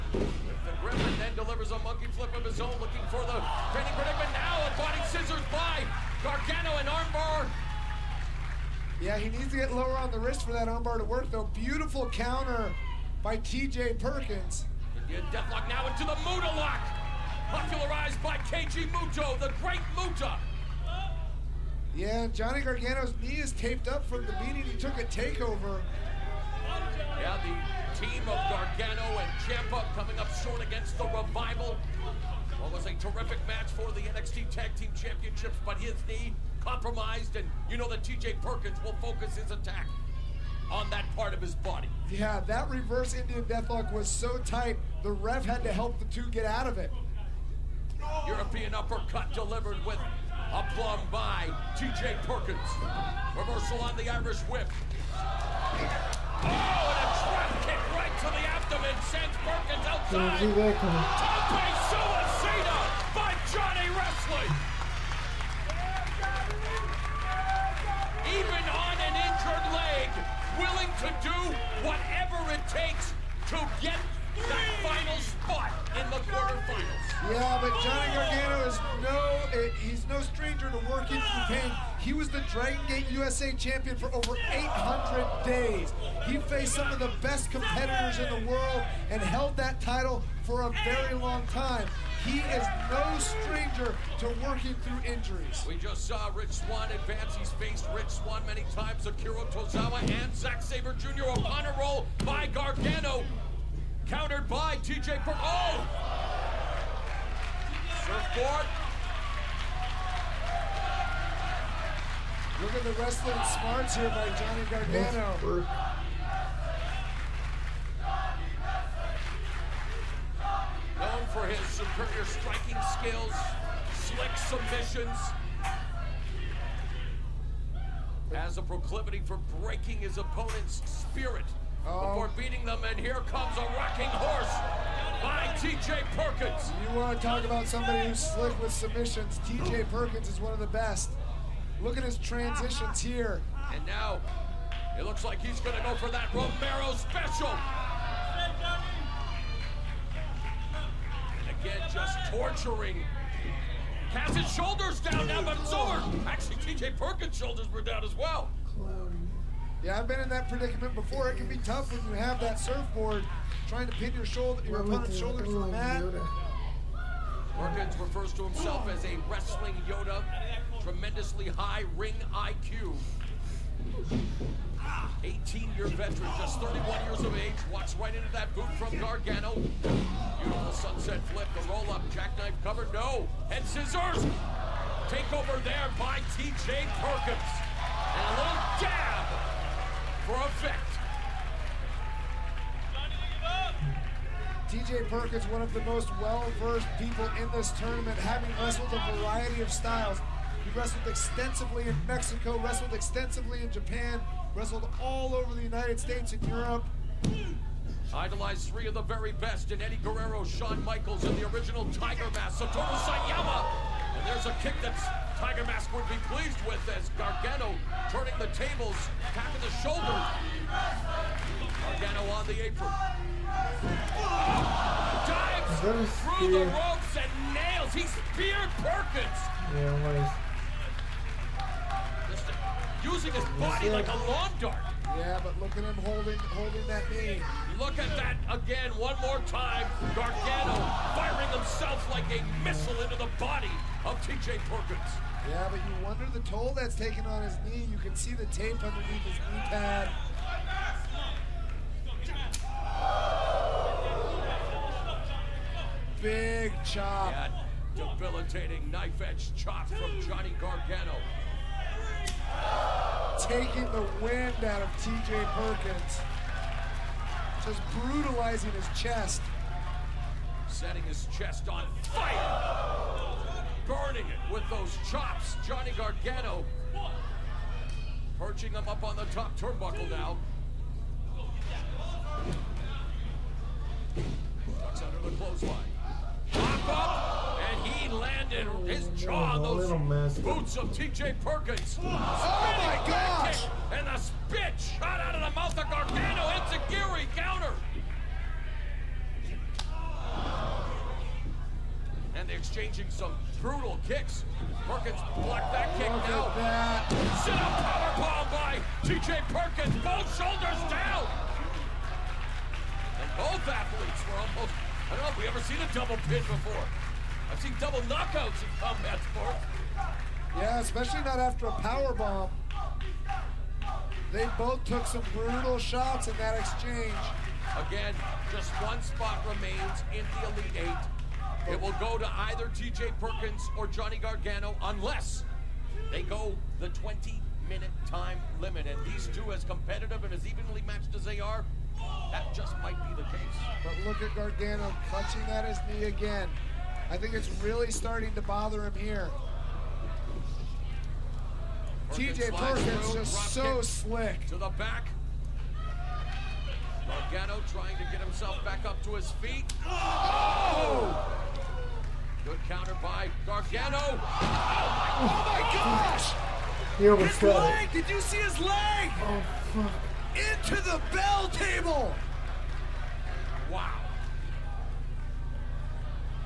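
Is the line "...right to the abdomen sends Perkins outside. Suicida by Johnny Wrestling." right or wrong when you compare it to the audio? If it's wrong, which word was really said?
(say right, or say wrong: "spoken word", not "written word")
right.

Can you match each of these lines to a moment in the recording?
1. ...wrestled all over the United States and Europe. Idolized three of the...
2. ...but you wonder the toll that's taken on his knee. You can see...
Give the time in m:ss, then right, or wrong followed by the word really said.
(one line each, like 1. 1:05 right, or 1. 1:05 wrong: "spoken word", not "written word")
1. 3:24 right
2. 4:05 right.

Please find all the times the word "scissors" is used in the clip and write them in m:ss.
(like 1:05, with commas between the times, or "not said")
0:05, 3:03.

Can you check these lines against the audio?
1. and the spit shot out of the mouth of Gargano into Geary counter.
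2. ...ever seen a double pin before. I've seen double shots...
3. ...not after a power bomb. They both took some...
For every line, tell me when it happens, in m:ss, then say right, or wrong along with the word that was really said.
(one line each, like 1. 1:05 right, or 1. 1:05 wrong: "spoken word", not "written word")
1. 4:53 right
2. 5:15 wrong: "knockouts", not "shots"
3. 5:21 right.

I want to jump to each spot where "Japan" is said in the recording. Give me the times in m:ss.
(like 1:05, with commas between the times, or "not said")
3:23.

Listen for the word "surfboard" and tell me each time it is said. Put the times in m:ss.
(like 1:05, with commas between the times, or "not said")
1:48, 2:42.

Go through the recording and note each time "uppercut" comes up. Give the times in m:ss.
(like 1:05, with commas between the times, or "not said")
0:48.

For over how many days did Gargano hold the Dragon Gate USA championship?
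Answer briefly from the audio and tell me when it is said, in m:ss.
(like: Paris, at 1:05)
800, at 1:24.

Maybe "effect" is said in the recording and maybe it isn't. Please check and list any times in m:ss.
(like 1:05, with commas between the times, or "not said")
3:10.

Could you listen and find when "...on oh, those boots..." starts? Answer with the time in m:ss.
4:49.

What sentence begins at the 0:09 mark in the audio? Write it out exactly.
Yeah, he needs to get lower on the wrist for that armbar to work, though.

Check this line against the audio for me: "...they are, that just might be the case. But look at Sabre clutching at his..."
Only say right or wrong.
wrong.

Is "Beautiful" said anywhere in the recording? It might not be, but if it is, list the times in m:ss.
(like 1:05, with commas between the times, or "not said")
0:11, 2:59.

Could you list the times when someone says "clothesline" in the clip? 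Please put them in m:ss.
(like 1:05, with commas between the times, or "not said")
4:45.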